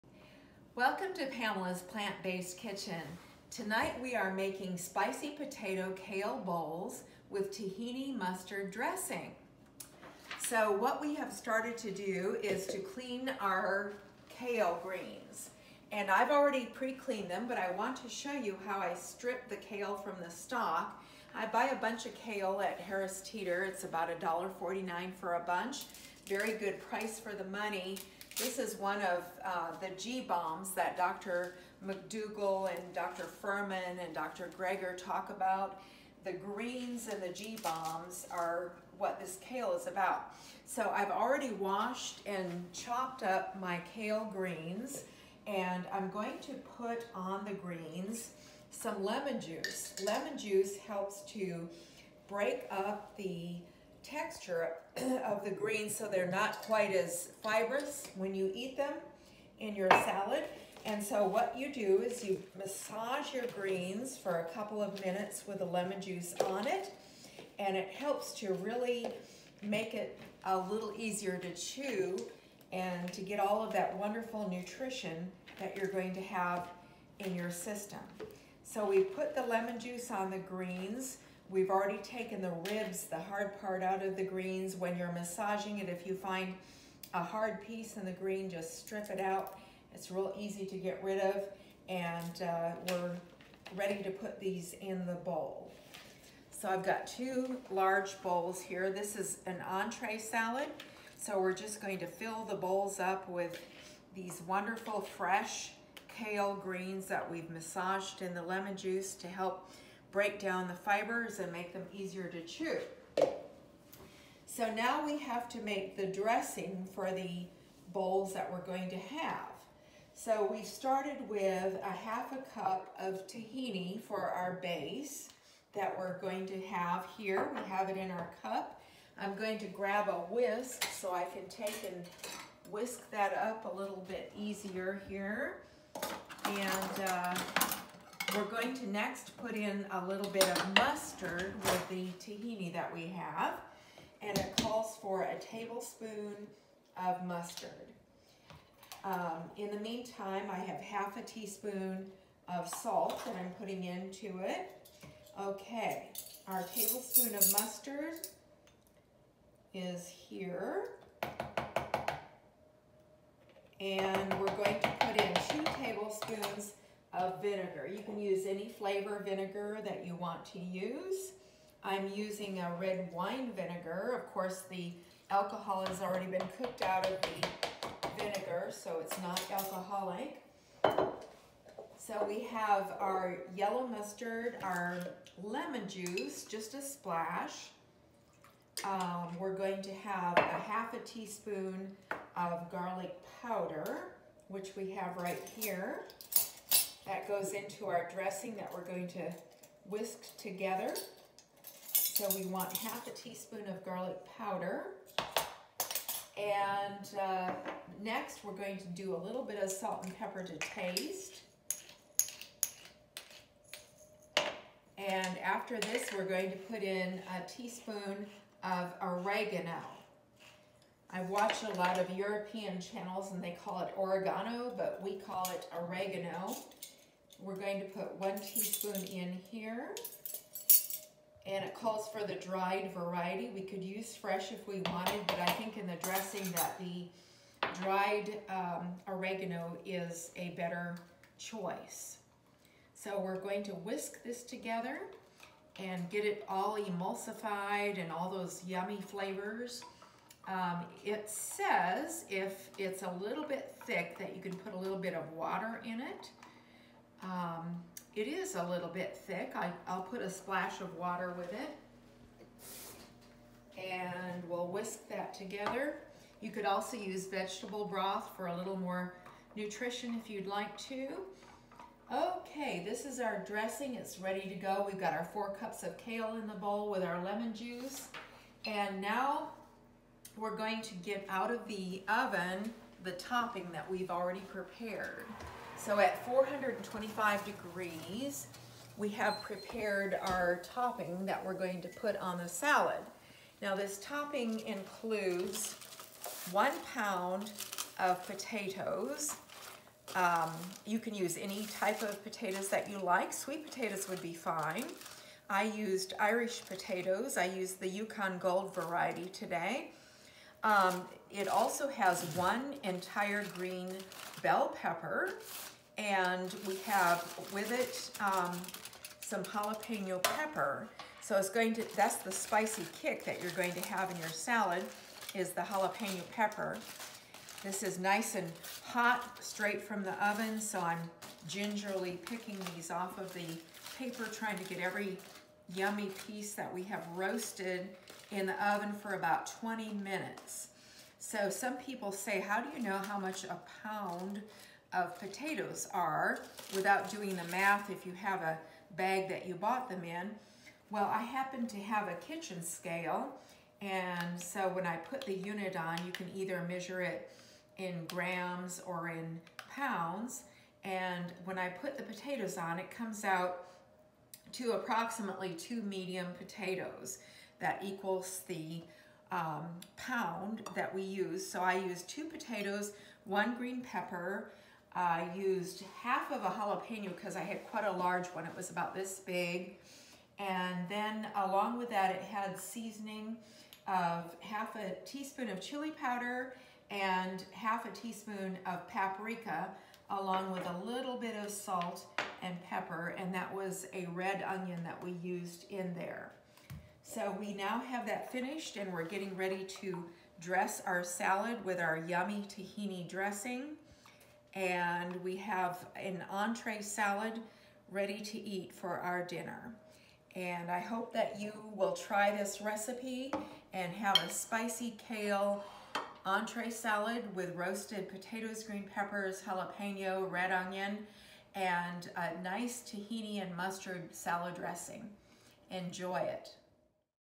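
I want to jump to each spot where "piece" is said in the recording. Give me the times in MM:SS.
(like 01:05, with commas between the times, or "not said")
01:27, 05:36.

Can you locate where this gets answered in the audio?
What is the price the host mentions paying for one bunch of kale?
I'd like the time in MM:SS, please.
00:24.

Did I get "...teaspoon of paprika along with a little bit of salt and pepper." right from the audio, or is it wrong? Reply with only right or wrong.
right.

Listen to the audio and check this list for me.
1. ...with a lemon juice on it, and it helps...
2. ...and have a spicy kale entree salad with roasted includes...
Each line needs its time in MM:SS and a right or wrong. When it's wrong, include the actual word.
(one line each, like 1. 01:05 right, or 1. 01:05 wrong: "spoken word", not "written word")
1. 01:05 right
2. 06:53 wrong: "potatoes", not "includes".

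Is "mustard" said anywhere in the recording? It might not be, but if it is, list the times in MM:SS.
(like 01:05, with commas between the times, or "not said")
00:08, 02:20, 02:27, 02:37, 03:03, 07:03.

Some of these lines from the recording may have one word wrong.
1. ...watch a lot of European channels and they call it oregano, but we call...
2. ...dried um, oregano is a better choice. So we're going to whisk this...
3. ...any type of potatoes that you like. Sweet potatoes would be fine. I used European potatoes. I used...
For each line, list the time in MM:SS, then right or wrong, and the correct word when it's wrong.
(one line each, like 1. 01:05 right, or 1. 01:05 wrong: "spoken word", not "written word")
1. 03:41 right
2. 03:57 right
3. 05:01 wrong: "Irish", not "European".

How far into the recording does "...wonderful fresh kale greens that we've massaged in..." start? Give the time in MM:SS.
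01:44.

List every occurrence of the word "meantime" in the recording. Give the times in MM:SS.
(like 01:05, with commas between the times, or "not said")
02:29.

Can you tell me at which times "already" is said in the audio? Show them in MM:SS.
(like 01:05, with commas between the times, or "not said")
00:16, 00:41, 01:21, 02:56, 04:44.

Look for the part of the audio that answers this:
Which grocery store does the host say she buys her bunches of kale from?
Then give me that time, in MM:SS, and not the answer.
00:22.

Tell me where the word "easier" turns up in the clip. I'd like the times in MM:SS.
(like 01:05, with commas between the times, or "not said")
01:10, 01:51, 02:14.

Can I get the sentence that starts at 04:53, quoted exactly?
Now this topping includes one pound of potatoes.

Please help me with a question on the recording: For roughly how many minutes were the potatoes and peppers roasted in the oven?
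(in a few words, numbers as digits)
20 minutes.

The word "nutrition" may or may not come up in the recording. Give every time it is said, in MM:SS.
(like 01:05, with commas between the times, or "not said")
01:14, 04:29.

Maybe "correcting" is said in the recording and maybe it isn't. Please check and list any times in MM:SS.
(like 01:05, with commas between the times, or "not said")
not said.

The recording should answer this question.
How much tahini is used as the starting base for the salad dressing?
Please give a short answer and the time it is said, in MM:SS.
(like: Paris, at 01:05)
half a cup, at 02:01.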